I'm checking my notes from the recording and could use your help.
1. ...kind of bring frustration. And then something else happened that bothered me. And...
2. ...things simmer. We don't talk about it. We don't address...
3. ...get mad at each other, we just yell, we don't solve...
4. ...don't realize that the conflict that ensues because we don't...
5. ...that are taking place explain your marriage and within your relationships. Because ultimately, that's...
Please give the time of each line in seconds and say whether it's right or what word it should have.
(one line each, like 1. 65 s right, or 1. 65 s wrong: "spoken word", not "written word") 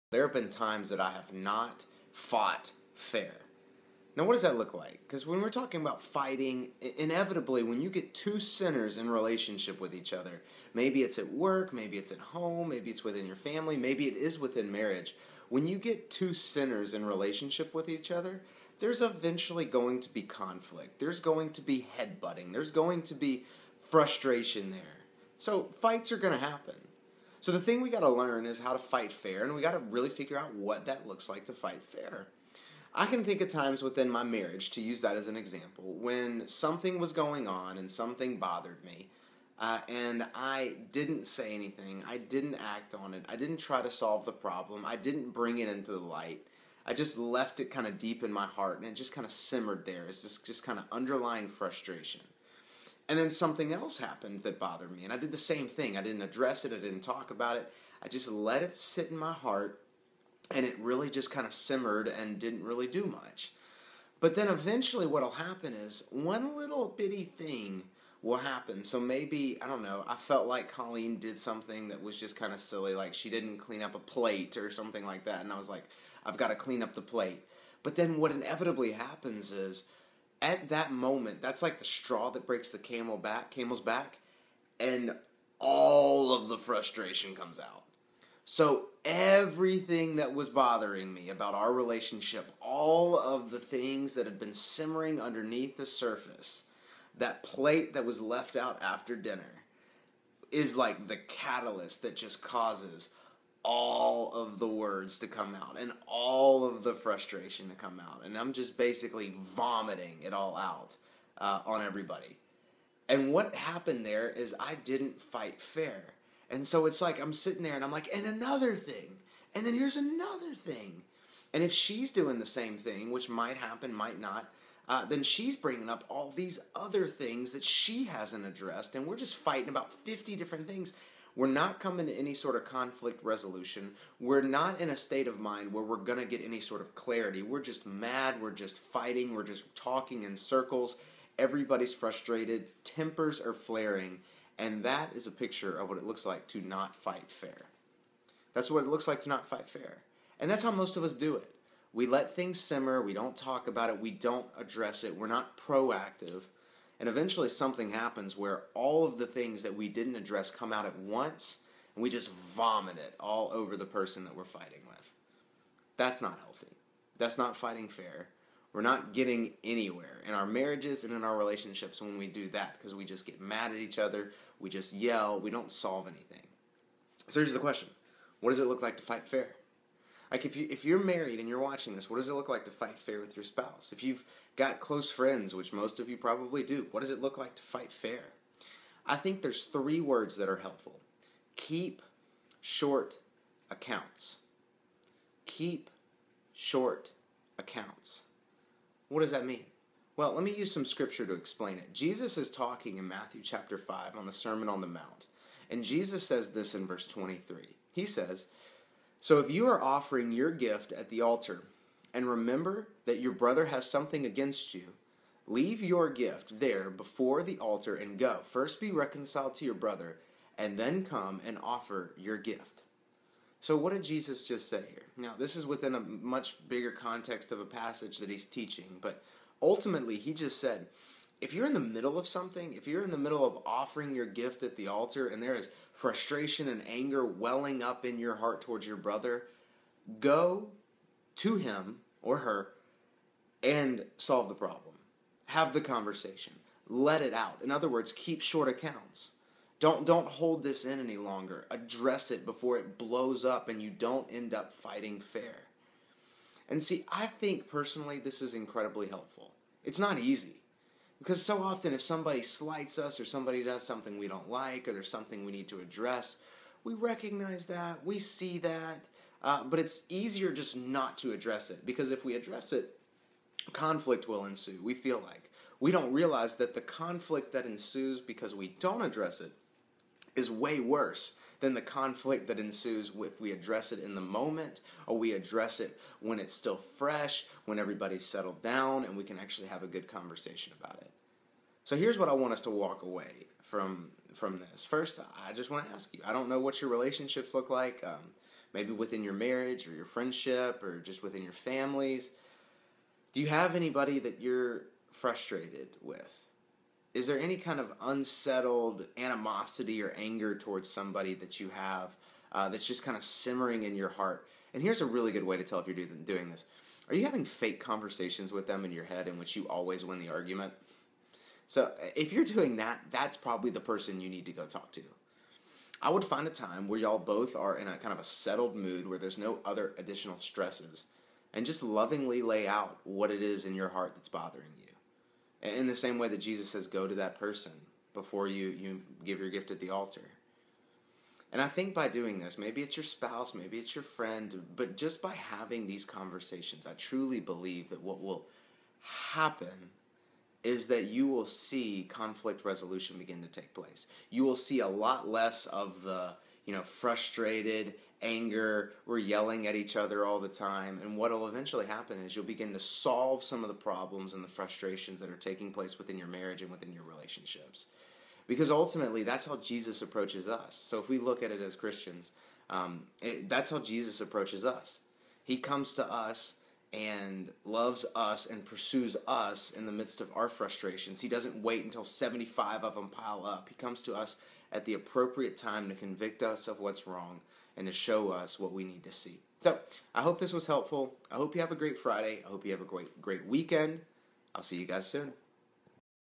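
1. 50 s wrong: "underlying", not "bring"
2. 152 s right
3. 173 s right
4. 275 s right
5. 365 s wrong: "within", not "explain".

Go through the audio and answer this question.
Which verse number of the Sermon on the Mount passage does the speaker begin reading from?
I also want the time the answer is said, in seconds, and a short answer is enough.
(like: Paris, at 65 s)
23, at 206 s.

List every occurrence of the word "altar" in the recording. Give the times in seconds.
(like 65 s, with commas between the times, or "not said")
211 s, 217 s, 234 s, 339 s.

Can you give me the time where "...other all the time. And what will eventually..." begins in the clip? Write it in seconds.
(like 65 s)
359 s.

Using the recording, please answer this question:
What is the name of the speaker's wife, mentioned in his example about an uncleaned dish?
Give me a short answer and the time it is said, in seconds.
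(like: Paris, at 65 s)
Colleen, at 70 s.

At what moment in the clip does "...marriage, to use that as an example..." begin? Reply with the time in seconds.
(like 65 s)
34 s.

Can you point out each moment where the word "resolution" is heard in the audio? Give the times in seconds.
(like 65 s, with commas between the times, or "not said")
133 s, 352 s.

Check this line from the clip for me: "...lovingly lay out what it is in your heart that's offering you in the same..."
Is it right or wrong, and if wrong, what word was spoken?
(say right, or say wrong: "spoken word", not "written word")
wrong: "bothering", not "offering".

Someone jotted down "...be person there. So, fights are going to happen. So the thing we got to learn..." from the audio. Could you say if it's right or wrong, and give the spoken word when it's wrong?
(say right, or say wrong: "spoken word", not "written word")
wrong: "frustration", not "person".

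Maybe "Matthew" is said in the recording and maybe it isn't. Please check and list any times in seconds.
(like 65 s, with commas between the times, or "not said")
203 s.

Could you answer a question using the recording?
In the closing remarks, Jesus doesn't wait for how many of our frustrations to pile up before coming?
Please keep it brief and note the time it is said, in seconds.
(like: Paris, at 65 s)
75, at 382 s.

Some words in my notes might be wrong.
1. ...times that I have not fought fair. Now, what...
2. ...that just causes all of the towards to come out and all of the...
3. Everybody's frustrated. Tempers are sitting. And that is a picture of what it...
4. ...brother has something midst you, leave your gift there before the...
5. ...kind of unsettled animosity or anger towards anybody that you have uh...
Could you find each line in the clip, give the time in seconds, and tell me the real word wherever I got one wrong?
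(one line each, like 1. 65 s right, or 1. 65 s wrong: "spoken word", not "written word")
1. 0 s right
2. 102 s wrong: "words", not "towards"
3. 141 s wrong: "flaring", not "sitting"
4. 213 s wrong: "against", not "midst"
5. 307 s wrong: "somebody", not "anybody".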